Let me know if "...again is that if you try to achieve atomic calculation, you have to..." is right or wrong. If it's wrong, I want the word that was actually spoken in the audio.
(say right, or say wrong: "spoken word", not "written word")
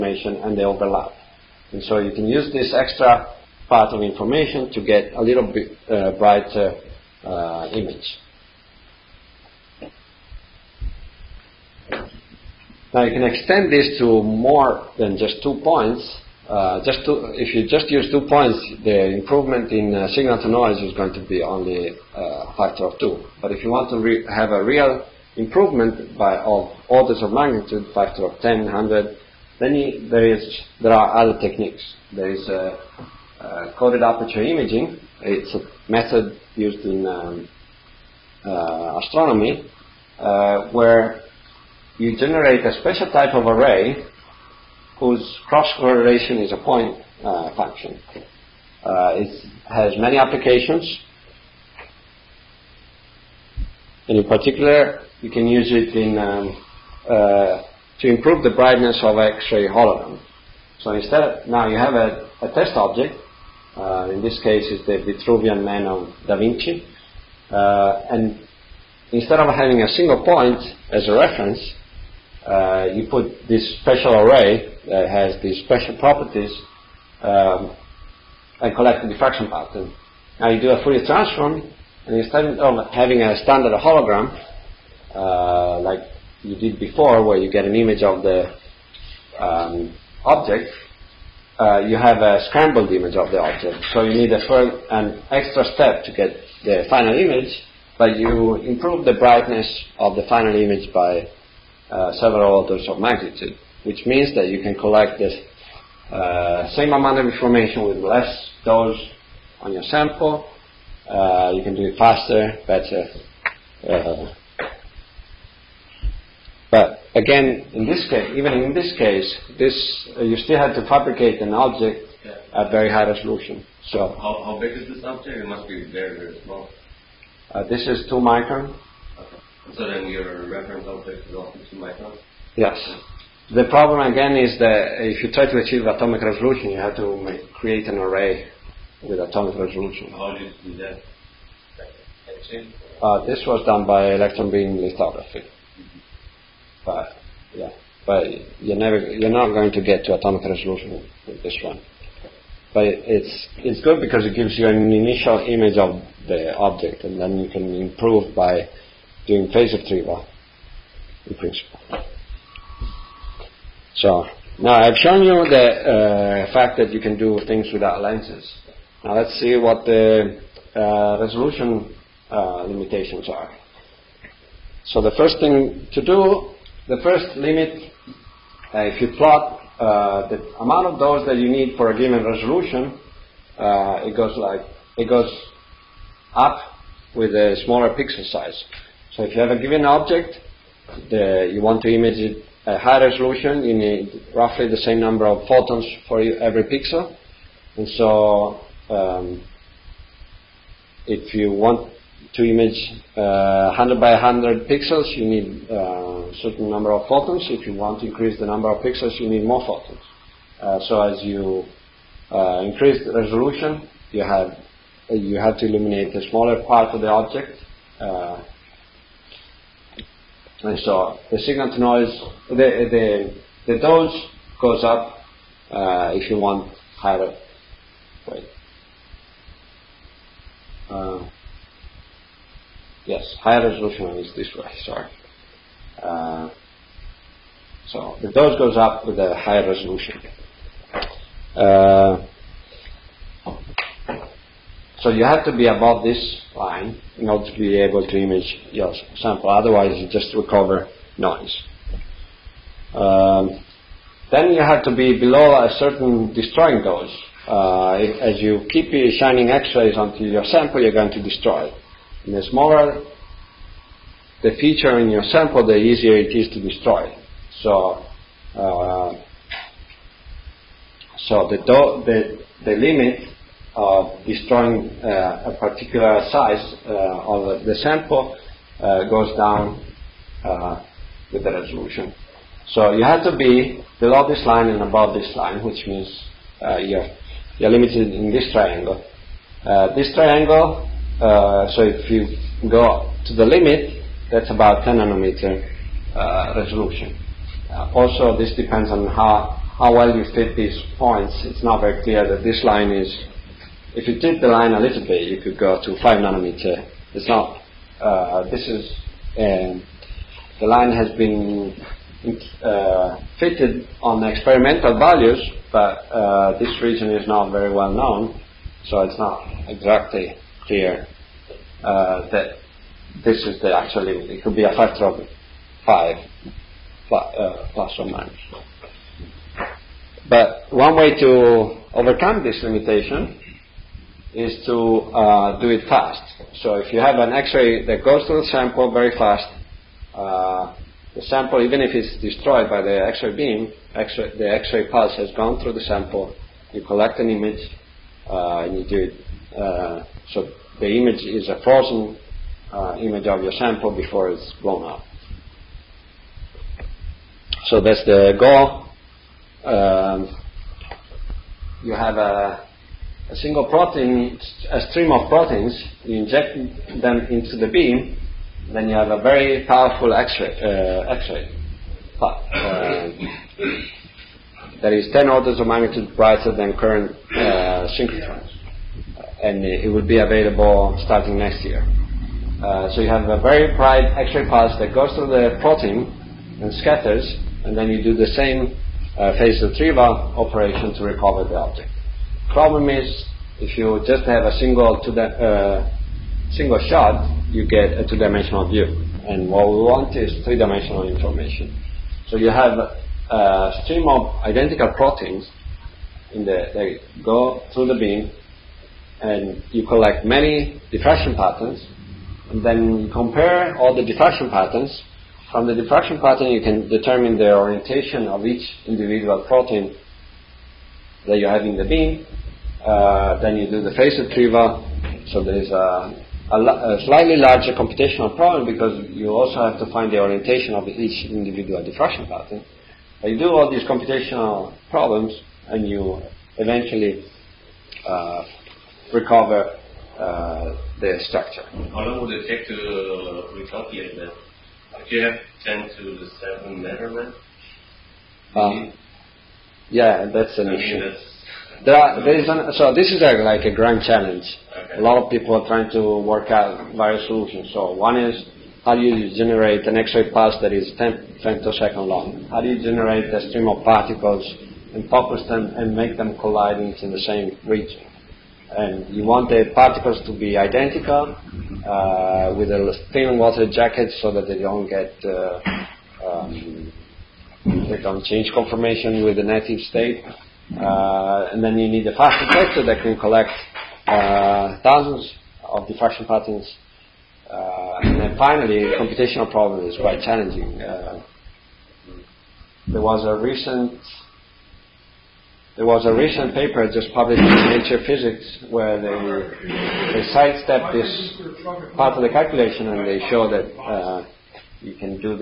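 wrong: "resolution", not "calculation".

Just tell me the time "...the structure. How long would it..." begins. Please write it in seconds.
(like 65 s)
440 s.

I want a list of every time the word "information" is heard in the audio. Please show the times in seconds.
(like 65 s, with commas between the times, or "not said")
4 s, 107 s, 401 s.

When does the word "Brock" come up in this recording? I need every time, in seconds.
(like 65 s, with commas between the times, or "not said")
not said.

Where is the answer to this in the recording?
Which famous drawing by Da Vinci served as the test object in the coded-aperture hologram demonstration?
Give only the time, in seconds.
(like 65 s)
65 s.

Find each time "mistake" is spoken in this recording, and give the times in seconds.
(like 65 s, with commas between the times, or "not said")
not said.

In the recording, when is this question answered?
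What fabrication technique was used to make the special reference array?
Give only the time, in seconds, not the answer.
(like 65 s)
144 s.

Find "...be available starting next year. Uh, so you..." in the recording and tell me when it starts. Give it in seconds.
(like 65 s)
380 s.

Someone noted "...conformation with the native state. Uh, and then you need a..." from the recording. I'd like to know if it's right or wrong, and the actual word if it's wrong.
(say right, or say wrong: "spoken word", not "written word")
right.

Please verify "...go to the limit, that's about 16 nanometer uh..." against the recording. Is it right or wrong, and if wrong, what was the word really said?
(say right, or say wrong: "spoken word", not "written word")
wrong: "10", not "16".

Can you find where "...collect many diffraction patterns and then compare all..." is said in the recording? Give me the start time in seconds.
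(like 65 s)
409 s.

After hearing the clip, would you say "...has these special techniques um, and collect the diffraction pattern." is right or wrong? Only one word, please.
wrong.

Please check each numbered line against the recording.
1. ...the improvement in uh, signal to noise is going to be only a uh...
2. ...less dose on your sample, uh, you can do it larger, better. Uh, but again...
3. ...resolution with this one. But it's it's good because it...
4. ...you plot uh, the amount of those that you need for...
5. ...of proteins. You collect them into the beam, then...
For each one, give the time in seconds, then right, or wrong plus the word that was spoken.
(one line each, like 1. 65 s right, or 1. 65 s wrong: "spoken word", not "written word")
1. 18 s right
2. 107 s wrong: "faster", not "larger"
3. 150 s right
4. 178 s right
5. 365 s wrong: "inject", not "collect".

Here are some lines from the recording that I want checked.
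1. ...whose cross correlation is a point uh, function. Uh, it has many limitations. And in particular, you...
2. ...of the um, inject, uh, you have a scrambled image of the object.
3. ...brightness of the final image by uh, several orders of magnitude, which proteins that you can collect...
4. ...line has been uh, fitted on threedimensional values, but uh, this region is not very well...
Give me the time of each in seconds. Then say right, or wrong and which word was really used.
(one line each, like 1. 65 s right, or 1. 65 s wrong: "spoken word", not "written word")
1. 44 s wrong: "applications", not "limitations"
2. 88 s wrong: "object", not "inject"
3. 99 s wrong: "means", not "proteins"
4. 310 s wrong: "experimental", not "threedimensional".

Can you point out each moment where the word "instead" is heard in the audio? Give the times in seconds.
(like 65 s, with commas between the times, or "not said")
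60 s, 69 s, 82 s.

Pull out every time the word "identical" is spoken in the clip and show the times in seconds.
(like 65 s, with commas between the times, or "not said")
404 s, 470 s.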